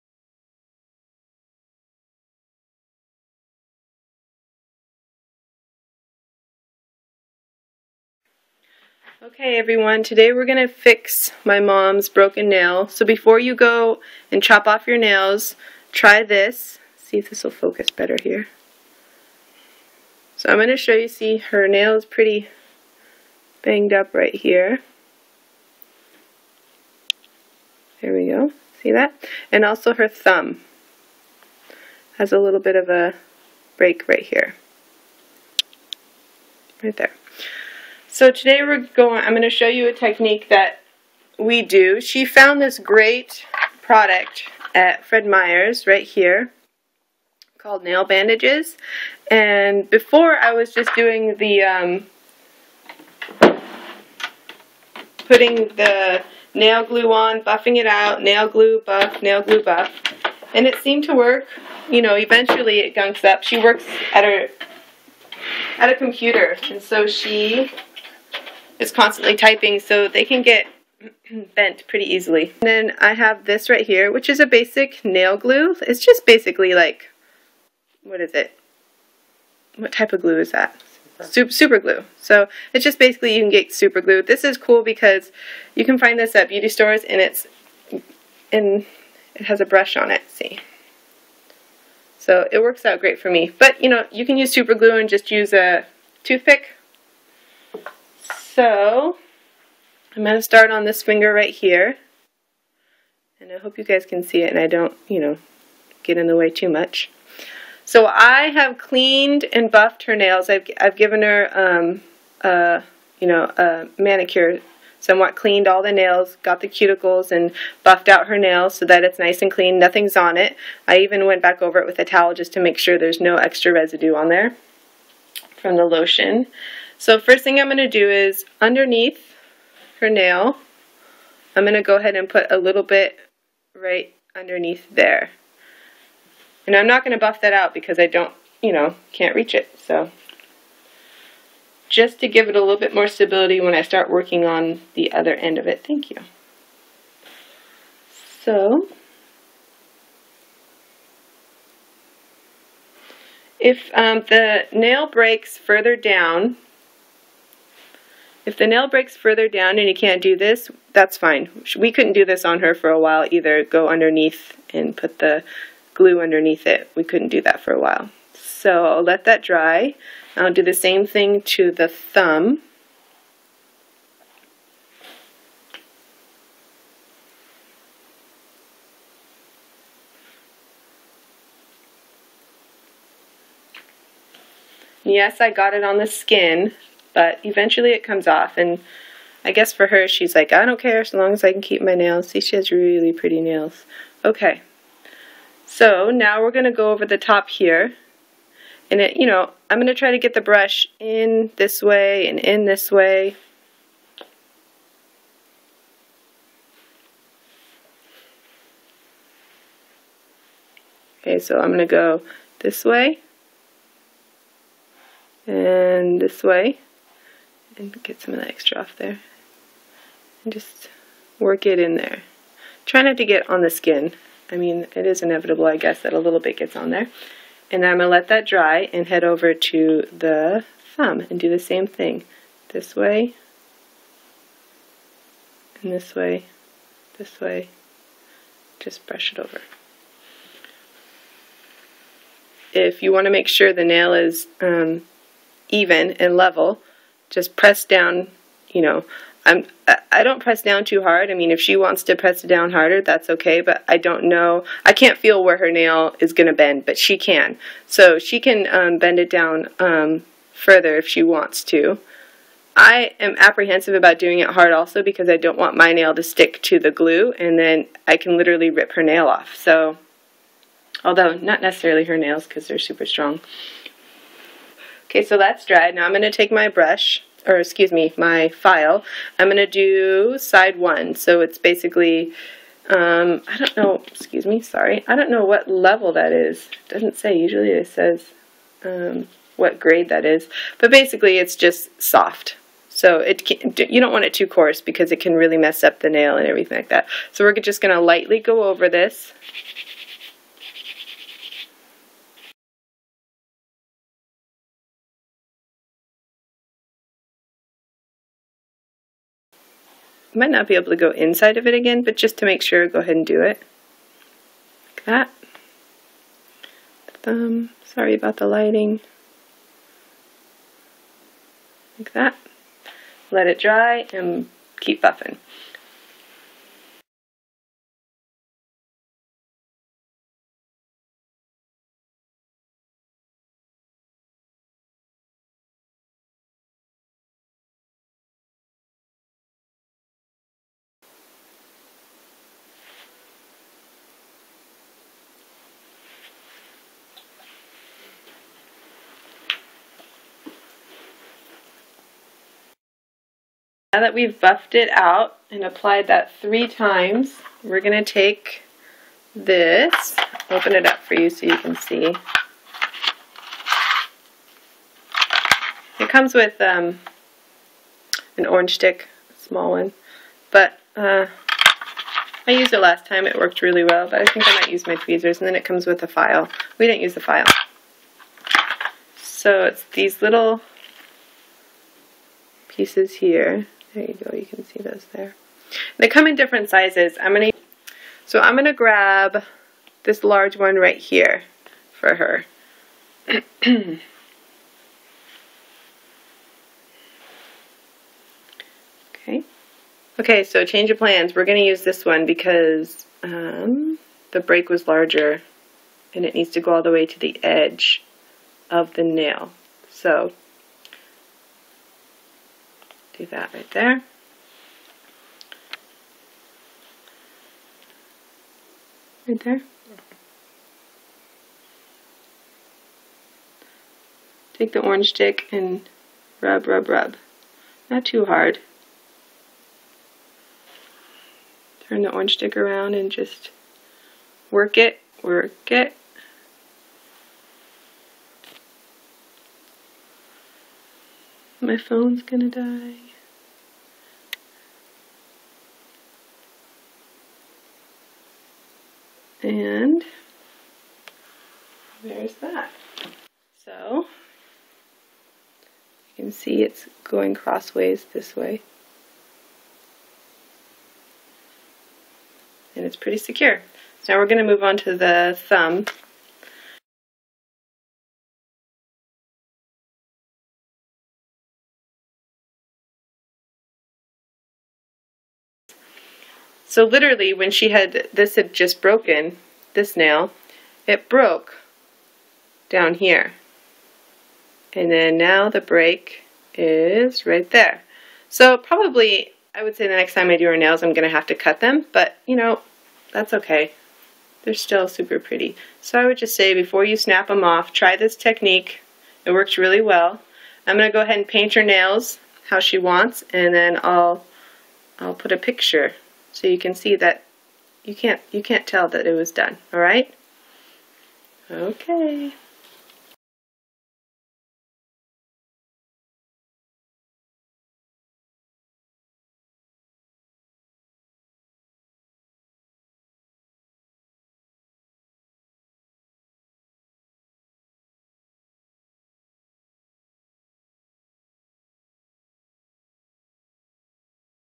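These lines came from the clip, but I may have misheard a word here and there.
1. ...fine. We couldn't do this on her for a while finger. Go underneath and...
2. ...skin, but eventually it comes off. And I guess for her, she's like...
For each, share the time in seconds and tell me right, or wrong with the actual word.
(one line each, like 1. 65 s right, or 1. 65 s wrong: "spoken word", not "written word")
1. 161 s wrong: "either", not "finger"
2. 186 s right.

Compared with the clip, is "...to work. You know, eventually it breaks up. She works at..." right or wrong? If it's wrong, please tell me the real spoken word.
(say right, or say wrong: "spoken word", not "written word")
wrong: "gunks", not "breaks".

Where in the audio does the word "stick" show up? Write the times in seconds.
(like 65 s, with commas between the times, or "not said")
266 s, 368 s, 425 s, 432 s.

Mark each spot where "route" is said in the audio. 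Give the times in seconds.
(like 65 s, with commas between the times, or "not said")
not said.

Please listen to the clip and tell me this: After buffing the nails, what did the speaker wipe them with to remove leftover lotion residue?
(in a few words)
a towel.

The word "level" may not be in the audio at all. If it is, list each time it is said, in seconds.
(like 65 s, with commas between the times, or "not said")
246 s, 285 s.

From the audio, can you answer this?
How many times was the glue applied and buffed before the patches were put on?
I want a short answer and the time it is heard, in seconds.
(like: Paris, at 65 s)
3, at 356 s.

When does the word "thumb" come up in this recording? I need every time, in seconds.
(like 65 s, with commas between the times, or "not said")
30 s, 171 s, 230 s, 317 s, 465 s.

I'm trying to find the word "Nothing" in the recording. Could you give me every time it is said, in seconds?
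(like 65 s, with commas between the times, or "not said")
119 s.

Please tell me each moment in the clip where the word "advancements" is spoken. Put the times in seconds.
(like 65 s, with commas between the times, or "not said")
not said.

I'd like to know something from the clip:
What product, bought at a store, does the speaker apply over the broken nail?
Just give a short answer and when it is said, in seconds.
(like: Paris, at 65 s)
nail bandages, at 47 s.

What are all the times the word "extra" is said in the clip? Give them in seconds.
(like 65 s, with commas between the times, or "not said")
123 s, 218 s.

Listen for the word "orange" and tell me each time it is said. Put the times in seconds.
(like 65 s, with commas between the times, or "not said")
368 s, 424 s, 432 s.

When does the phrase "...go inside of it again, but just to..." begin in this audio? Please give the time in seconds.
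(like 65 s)
310 s.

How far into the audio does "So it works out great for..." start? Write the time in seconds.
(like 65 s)
92 s.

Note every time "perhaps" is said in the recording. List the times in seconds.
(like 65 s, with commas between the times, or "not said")
not said.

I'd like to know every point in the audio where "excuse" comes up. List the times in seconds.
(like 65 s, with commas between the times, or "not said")
277 s, 284 s.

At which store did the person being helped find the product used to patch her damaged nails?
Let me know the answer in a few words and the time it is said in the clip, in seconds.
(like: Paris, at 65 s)
Fred Meyer's, at 45 s.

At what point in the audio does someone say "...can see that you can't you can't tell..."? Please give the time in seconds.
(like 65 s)
506 s.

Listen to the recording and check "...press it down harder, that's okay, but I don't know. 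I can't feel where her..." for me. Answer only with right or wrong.
right.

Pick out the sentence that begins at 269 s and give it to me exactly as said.
So, although not necessarily her nails because they're super strong.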